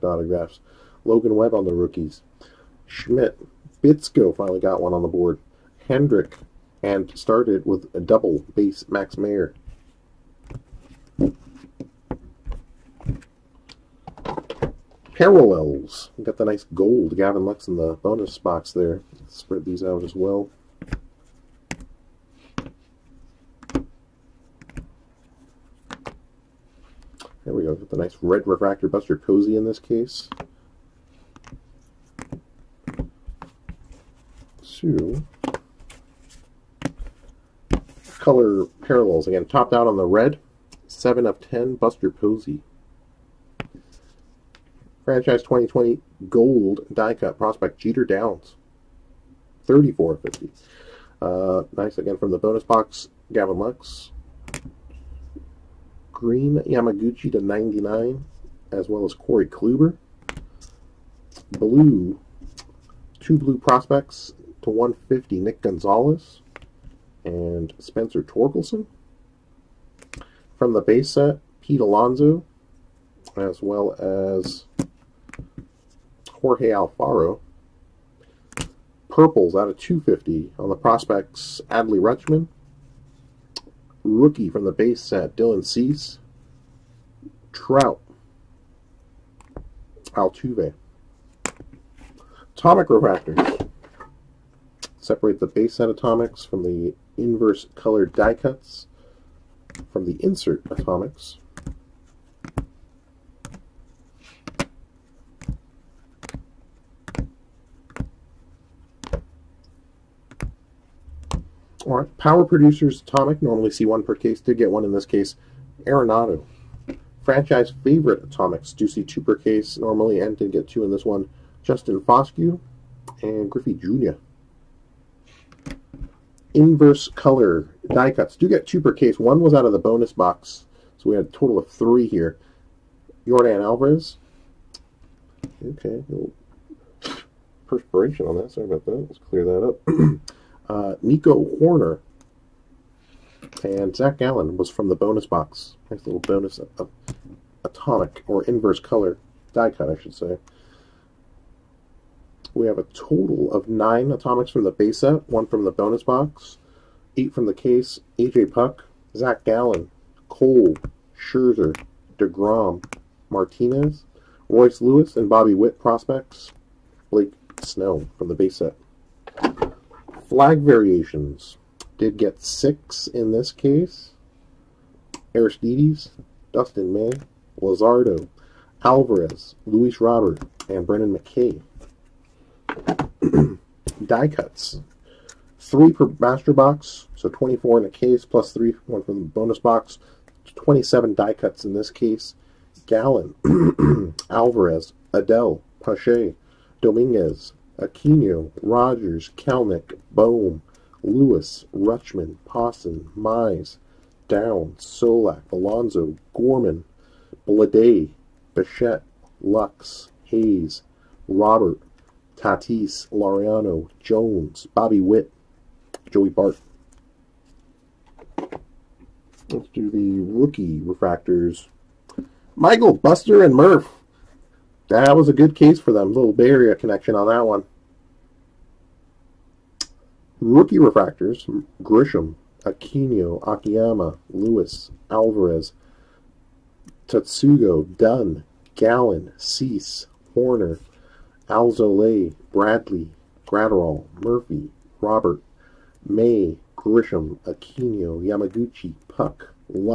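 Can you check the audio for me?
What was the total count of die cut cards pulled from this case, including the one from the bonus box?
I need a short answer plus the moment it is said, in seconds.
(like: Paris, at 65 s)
27, at 190 s.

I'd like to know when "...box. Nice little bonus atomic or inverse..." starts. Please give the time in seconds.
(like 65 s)
145 s.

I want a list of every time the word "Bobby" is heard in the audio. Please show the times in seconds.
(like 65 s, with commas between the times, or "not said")
165 s, 214 s.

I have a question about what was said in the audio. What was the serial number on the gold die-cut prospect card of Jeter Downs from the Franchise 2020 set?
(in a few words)
34 of 50.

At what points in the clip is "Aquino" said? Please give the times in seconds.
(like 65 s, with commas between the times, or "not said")
197 s, 232 s, 247 s.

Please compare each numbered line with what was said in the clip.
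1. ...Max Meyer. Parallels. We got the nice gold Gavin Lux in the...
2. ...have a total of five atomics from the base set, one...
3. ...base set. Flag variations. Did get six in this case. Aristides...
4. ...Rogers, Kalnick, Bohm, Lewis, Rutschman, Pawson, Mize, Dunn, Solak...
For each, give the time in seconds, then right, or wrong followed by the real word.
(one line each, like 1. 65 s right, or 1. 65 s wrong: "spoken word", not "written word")
1. 8 s right
2. 152 s wrong: "nine", not "five"
3. 168 s right
4. 198 s wrong: "Down", not "Dunn".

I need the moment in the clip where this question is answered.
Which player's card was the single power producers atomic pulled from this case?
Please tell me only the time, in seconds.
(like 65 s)
115 s.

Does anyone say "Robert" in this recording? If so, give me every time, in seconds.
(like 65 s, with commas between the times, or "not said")
180 s, 211 s, 245 s.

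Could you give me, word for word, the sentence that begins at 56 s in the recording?
Green Yamaguchi to 99, as well as Corey Kluber.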